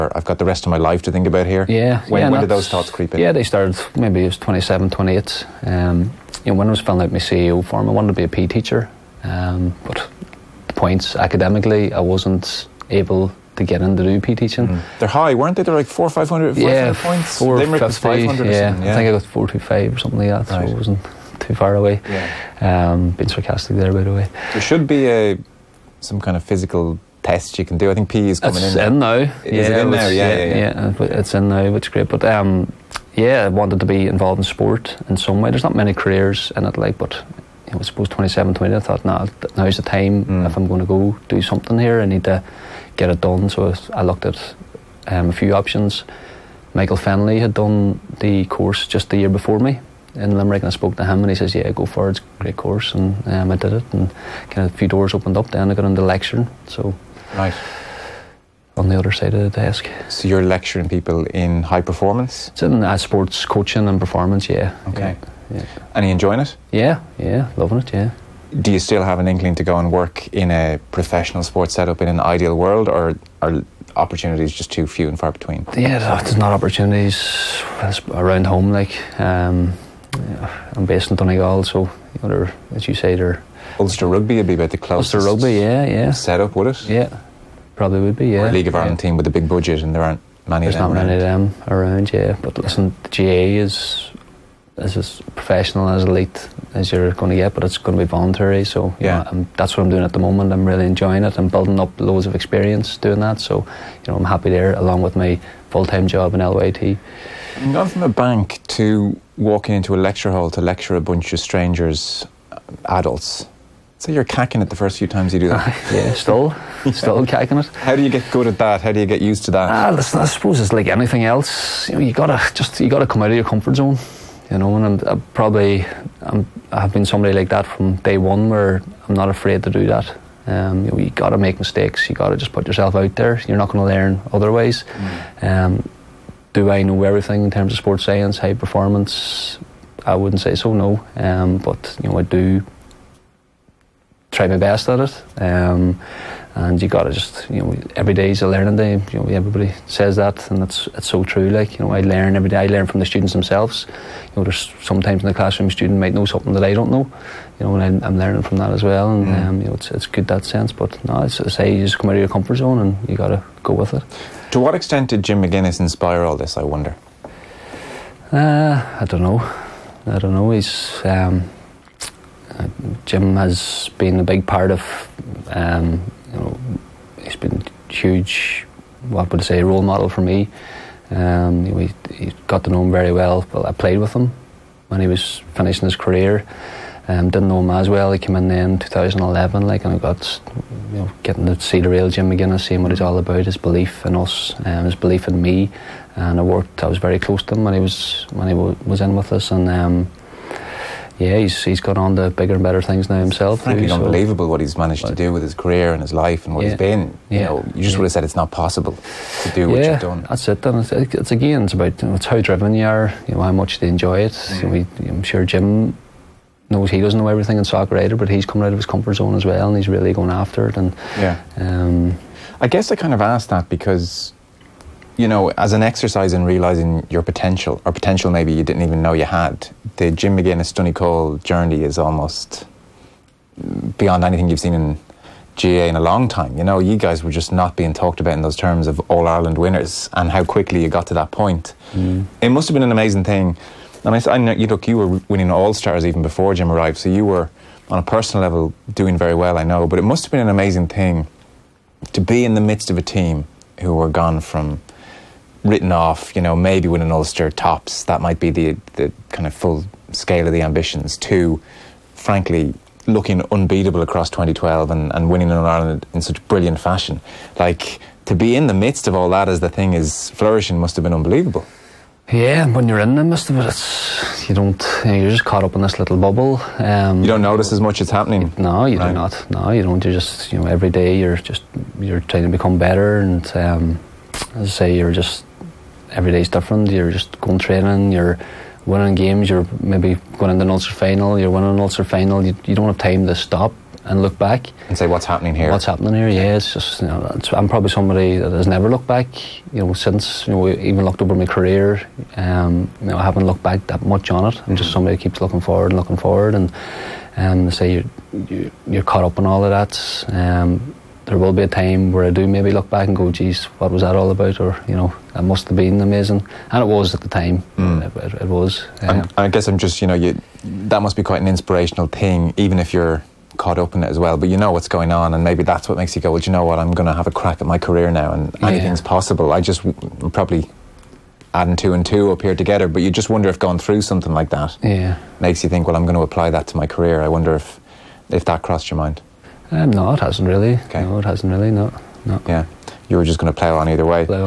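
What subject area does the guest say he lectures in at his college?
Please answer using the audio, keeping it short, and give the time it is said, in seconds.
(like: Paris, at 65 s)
sports coaching and performance, at 62 s.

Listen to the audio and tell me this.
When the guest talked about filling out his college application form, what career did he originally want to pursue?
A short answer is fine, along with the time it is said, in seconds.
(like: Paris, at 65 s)
PE teacher, at 8 s.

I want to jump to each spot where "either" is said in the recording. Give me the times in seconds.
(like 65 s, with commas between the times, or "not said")
217 s, 343 s.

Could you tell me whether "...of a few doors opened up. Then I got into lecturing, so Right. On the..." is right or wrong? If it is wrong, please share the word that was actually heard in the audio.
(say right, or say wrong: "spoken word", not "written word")
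right.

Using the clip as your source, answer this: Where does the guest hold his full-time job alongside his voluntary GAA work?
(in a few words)
LYIT.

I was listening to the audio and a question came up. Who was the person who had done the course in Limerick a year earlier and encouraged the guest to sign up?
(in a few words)
Michael Fenley.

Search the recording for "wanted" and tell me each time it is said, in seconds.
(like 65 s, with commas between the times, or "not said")
7 s, 33 s.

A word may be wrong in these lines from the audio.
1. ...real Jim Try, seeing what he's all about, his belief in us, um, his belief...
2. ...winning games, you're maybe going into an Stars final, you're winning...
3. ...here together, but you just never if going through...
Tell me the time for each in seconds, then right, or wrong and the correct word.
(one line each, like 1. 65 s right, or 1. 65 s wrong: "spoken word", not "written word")
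1. 191 s wrong: "McGuinness", not "Try"
2. 288 s wrong: "Ulster", not "Stars"
3. 332 s wrong: "wonder", not "never".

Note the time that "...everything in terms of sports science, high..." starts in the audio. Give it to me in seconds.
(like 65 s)
137 s.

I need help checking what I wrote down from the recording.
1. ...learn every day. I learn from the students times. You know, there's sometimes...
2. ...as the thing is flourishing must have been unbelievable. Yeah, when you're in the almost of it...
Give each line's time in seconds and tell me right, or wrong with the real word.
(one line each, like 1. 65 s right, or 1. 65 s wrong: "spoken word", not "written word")
1. 152 s wrong: "themselves", not "times"
2. 269 s wrong: "midst", not "almost".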